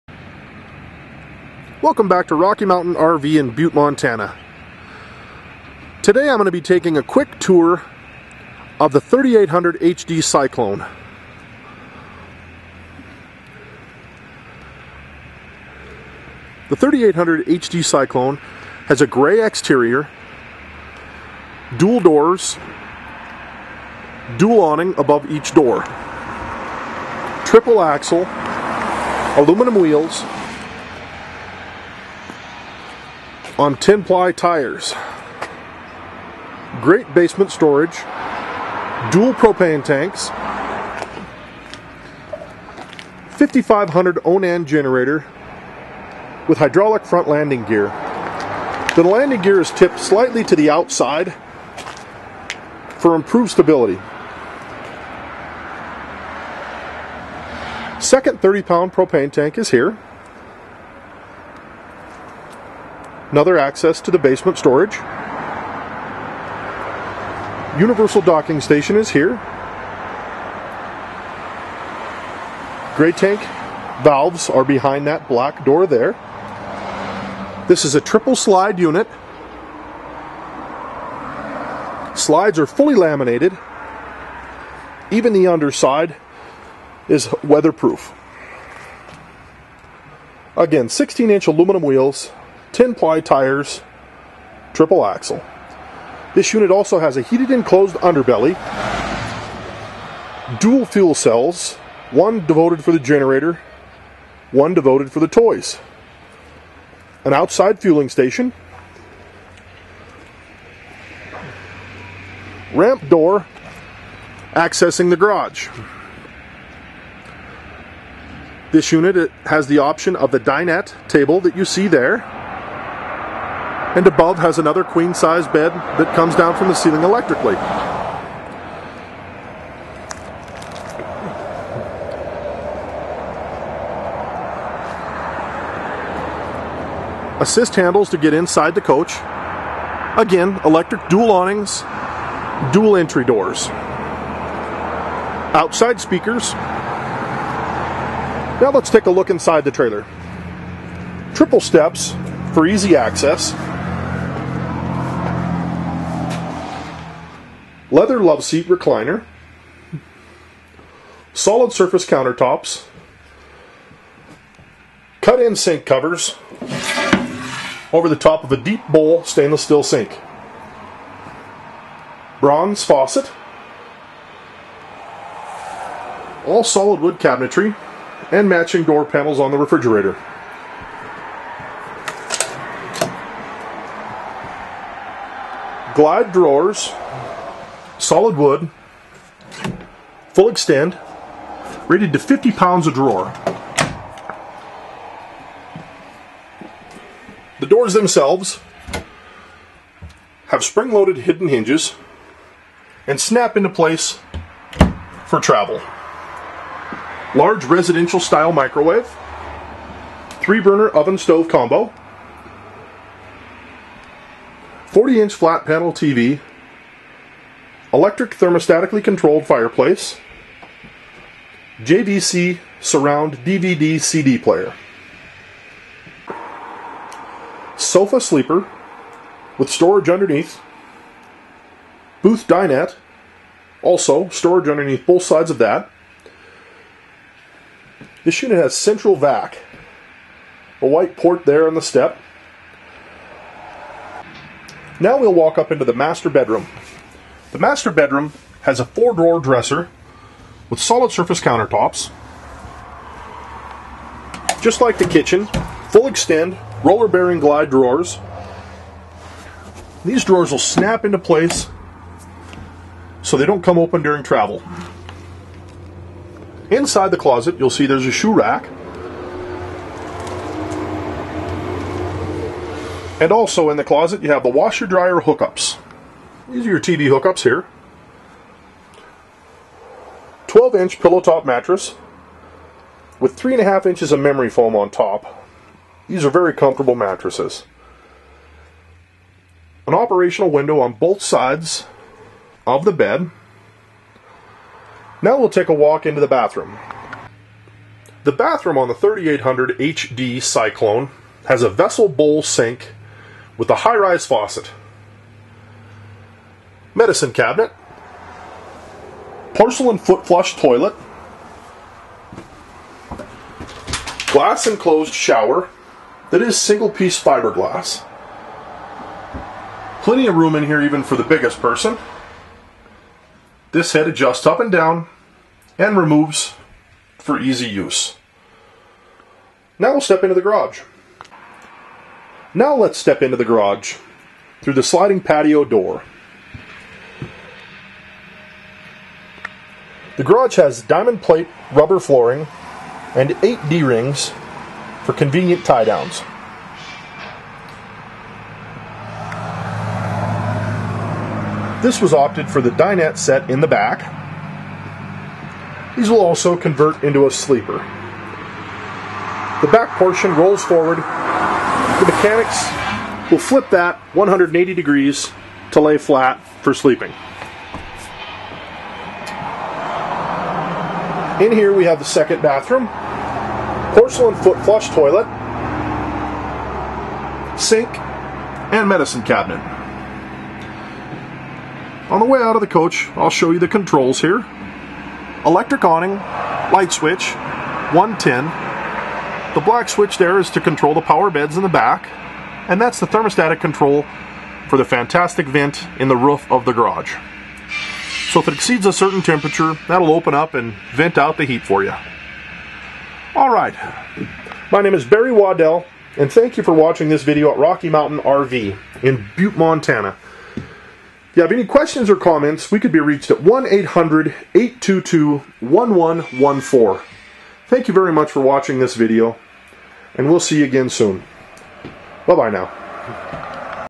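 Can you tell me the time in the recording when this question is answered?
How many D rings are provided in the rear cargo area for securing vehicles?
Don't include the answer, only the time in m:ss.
5:43.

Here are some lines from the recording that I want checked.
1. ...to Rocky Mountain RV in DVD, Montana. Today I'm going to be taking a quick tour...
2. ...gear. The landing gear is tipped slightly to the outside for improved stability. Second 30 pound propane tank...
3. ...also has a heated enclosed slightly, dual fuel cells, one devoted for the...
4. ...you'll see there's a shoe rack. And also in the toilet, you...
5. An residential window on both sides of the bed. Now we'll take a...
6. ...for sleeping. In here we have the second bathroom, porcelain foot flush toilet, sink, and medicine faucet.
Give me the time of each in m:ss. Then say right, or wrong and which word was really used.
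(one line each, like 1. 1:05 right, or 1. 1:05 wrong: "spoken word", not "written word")
1. 0:02 wrong: "Butte", not "DVD"
2. 0:47 right
3. 1:36 wrong: "underbelly", not "slightly"
4. 4:27 wrong: "closet", not "toilet"
5. 4:49 wrong: "operational", not "residential"
6. 6:06 wrong: "cabinet", not "faucet".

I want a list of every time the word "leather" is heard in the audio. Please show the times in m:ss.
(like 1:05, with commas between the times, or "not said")
2:37.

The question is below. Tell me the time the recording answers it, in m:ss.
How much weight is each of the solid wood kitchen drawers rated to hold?
3:12.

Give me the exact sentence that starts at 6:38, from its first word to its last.
So if it exceeds a certain temperature, that'll open up and vent out the heat for you.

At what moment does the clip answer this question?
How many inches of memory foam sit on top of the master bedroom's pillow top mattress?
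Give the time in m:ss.
4:43.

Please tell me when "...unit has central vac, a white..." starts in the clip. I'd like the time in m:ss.
3:58.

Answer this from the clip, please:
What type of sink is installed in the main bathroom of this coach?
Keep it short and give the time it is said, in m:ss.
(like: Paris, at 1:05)
vessel bowl sink, at 5:01.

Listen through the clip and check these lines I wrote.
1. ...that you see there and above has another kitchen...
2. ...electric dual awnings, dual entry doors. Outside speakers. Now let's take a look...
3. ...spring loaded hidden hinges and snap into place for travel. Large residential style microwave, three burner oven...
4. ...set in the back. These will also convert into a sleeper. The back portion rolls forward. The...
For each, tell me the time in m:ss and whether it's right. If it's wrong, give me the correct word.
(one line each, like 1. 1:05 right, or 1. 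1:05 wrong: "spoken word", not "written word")
1. 2:01 wrong: "queen", not "kitchen"
2. 2:20 right
3. 3:20 right
4. 5:53 right.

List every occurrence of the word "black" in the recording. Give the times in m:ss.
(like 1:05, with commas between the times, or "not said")
1:15, 6:29.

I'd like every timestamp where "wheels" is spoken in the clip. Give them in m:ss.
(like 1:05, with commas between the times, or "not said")
0:29, 1:31.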